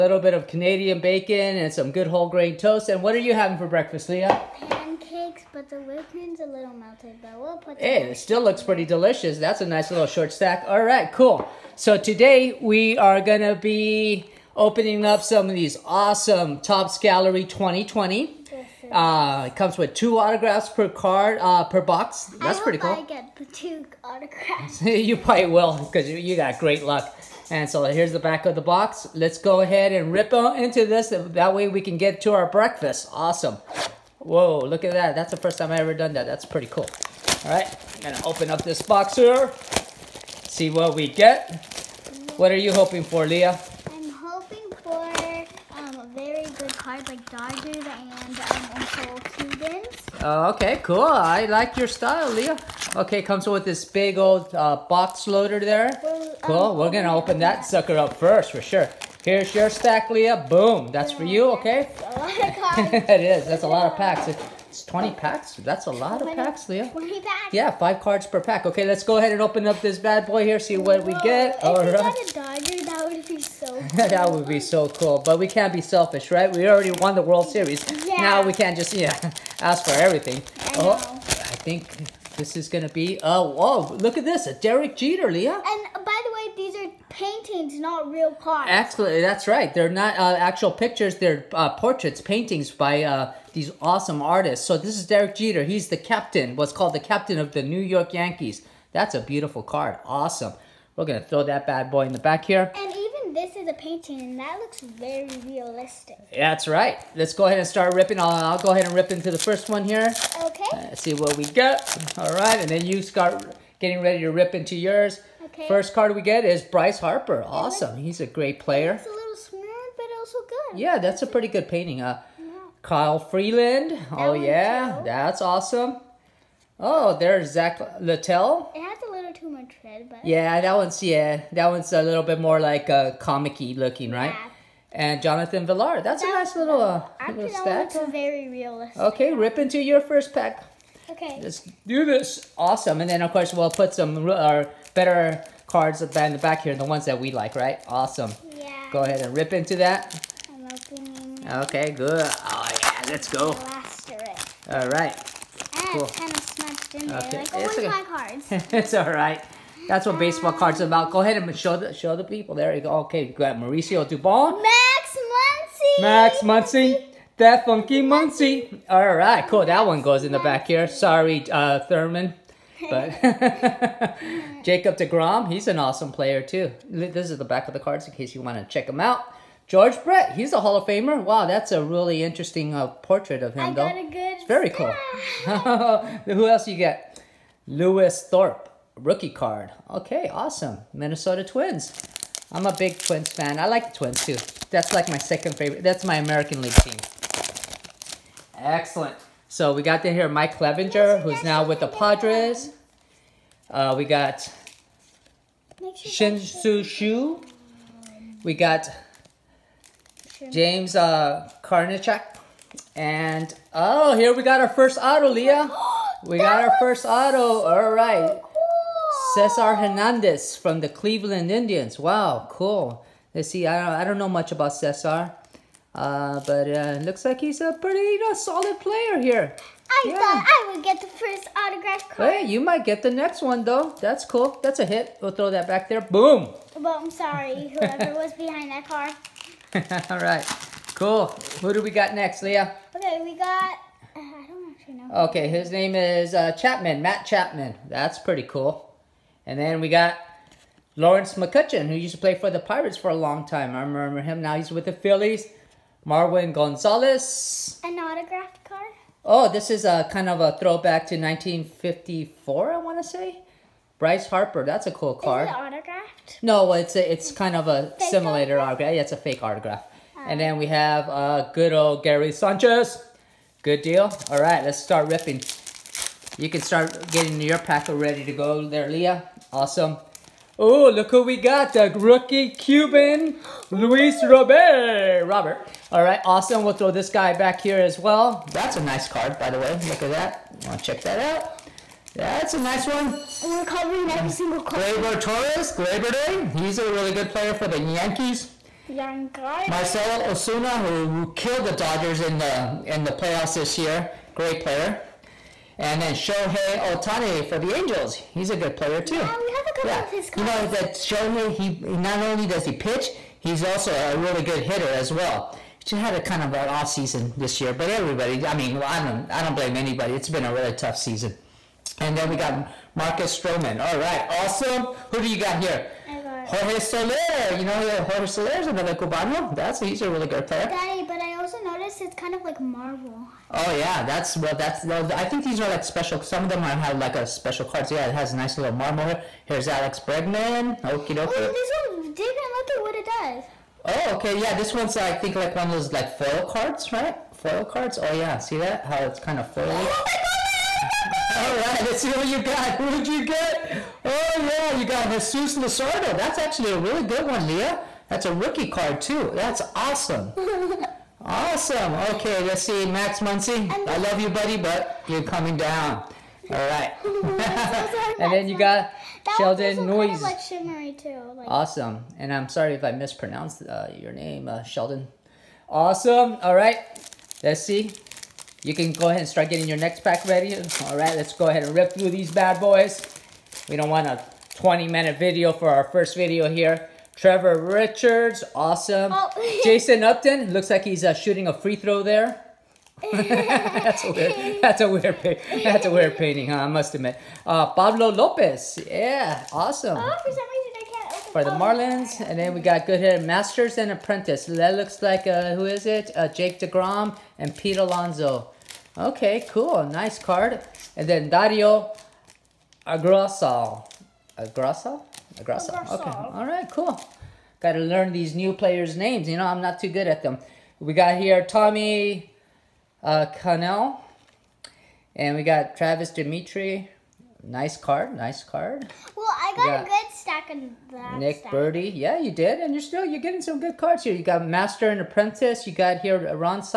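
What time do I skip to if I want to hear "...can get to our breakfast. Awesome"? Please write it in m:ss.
0:31.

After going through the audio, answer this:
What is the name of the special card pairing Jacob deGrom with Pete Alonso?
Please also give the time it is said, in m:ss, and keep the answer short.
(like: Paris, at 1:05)
Masters and Apprentice, at 6:43.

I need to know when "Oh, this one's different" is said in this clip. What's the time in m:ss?
5:41.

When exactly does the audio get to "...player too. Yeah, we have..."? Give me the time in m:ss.
5:08.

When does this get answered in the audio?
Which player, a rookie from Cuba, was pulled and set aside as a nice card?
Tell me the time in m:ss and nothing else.
4:43.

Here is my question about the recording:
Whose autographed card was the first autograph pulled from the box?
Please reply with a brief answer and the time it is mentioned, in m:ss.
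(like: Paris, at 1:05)
Cesar Hernandez, at 3:39.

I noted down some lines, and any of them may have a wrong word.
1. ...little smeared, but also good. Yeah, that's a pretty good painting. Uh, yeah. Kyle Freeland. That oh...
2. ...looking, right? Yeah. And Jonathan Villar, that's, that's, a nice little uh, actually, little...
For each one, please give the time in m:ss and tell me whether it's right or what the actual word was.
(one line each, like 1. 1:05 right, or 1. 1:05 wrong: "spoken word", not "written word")
1. 1:59 right
2. 2:13 right.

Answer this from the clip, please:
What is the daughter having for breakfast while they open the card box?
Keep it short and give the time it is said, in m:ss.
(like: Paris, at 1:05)
Pancakes, at 0:04.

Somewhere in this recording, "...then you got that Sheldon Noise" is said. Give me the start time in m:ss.
6:08.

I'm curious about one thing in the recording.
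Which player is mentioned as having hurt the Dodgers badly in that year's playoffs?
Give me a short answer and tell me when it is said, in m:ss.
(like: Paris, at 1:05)
Marcelo Ozuna, at 4:59.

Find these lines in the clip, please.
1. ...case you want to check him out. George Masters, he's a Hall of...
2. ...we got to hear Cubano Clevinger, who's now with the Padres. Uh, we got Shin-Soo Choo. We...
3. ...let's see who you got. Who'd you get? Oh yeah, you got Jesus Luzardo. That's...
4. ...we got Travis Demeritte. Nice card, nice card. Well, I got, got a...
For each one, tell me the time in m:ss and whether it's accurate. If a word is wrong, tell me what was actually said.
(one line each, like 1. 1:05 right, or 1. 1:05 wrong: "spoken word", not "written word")
1. 2:58 wrong: "Brett", not "Masters"
2. 3:19 wrong: "Mike", not "Cubano"
3. 5:51 right
4. 7:05 right.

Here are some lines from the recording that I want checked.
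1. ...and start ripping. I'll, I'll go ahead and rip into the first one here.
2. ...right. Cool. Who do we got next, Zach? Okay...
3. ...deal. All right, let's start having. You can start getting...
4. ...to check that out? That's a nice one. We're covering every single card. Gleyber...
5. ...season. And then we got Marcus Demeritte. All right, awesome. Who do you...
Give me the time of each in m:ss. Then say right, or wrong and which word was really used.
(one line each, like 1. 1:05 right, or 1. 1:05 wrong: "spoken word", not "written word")
1. 1:47 right
2. 4:00 wrong: "Leah", not "Zach"
3. 4:33 wrong: "ripping", not "having"
4. 4:50 right
5. 5:20 wrong: "Stroman", not "Demeritte".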